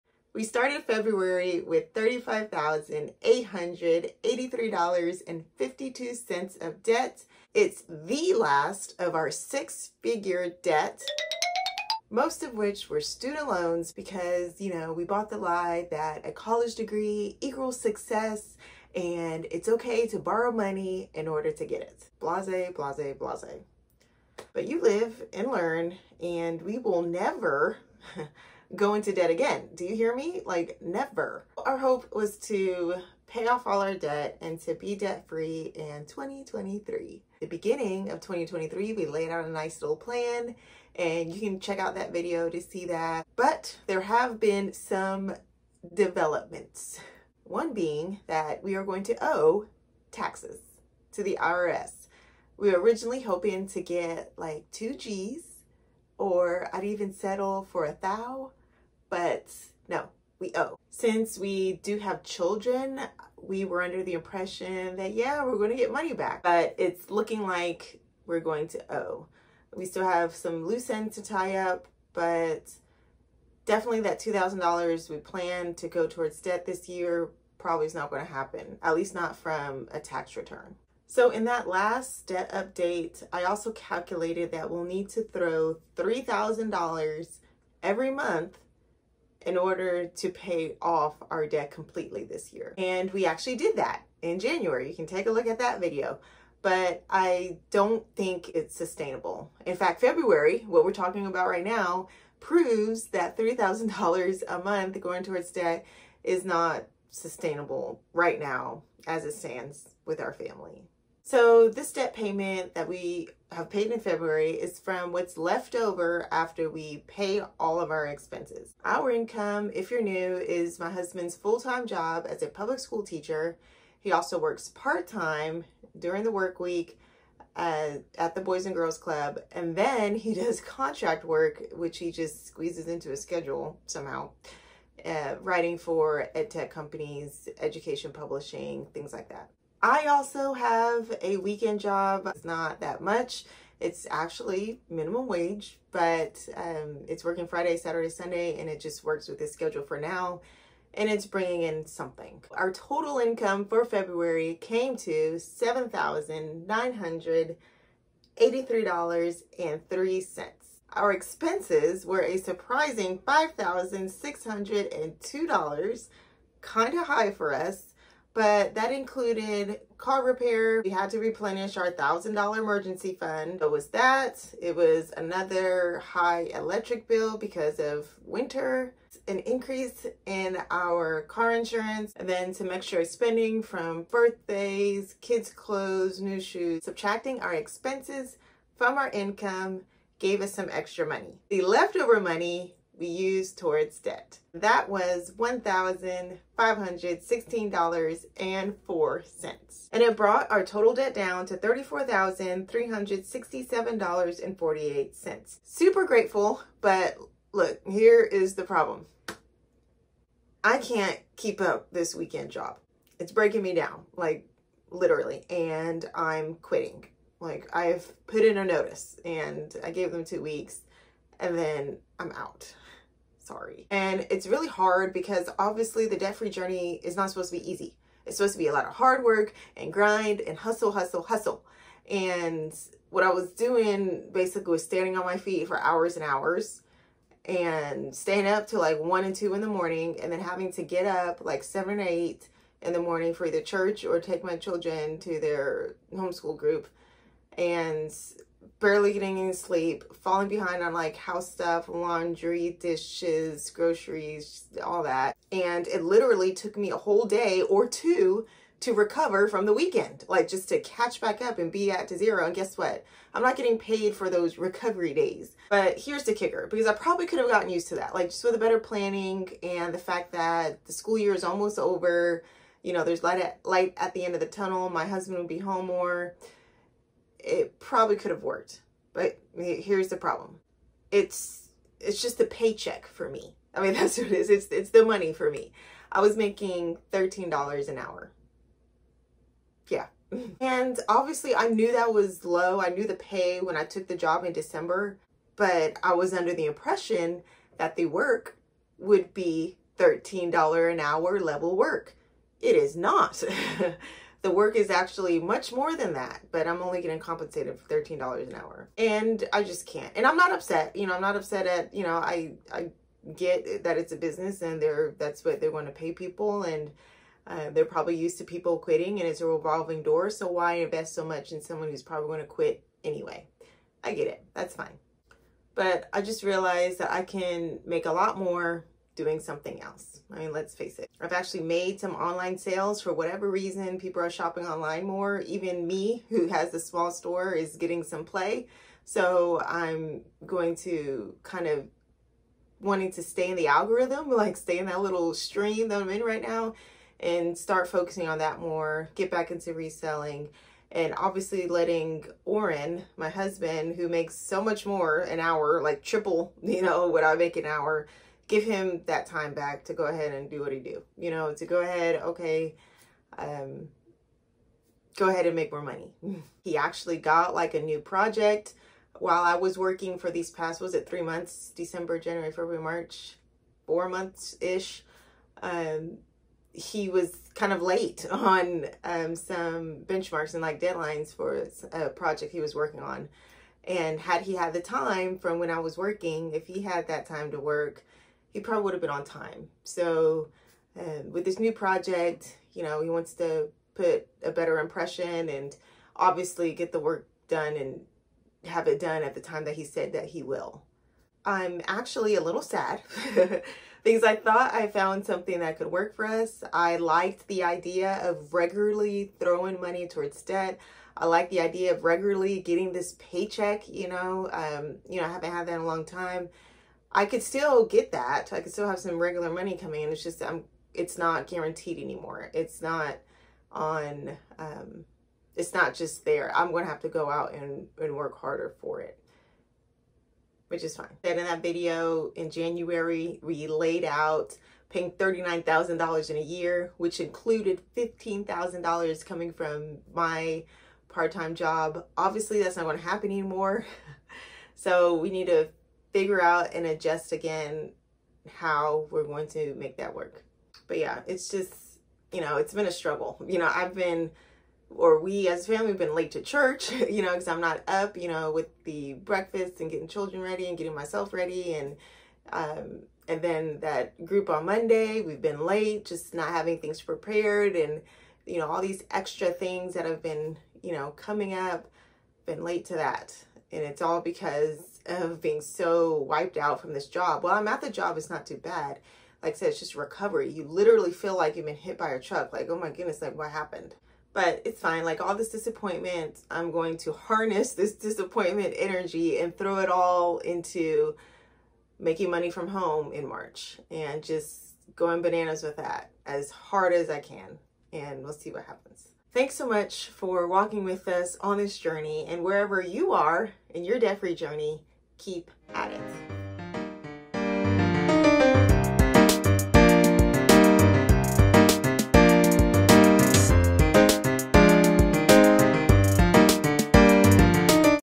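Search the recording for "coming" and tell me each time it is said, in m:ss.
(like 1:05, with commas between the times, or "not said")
6:59, 7:19, 7:51.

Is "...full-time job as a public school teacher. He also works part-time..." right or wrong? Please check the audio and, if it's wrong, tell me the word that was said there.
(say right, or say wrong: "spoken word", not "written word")
right.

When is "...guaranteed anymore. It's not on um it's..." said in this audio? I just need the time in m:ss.
7:01.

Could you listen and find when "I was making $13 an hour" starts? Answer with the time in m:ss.
4:46.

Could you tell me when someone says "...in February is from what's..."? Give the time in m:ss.
1:53.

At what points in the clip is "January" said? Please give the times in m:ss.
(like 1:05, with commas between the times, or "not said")
1:34, 6:12, 7:12.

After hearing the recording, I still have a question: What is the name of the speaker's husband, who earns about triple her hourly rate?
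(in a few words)
Oren.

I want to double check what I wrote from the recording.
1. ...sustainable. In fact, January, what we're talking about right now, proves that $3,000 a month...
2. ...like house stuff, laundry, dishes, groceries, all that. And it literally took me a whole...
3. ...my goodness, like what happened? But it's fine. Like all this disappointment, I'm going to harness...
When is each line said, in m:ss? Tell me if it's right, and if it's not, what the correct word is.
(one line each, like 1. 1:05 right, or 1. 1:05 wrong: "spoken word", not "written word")
1. 1:38 wrong: "February", not "January"
2. 4:10 right
3. 8:02 right.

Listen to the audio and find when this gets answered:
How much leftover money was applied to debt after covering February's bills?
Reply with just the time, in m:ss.
3:15.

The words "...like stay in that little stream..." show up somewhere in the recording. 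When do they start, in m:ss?
5:44.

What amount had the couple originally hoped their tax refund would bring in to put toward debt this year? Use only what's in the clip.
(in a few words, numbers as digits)
$2,000.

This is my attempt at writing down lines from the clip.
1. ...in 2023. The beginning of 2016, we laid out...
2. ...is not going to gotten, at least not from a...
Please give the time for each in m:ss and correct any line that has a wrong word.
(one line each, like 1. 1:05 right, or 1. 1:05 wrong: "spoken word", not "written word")
1. 0:35 wrong: "2023", not "2016"
2. 1:17 wrong: "happen", not "gotten".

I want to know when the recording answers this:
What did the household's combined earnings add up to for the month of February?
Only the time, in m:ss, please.
2:35.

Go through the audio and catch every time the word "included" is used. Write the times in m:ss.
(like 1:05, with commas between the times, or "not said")
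2:48, 7:17.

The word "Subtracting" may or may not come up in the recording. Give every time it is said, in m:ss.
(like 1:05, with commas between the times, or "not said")
3:06.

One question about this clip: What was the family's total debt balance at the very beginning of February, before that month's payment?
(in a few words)
$35,883.52.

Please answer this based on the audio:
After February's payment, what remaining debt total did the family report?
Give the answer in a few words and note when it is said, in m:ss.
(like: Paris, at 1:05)
$34,367.48, at 3:21.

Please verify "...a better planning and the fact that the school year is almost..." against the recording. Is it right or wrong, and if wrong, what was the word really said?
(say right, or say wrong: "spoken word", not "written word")
right.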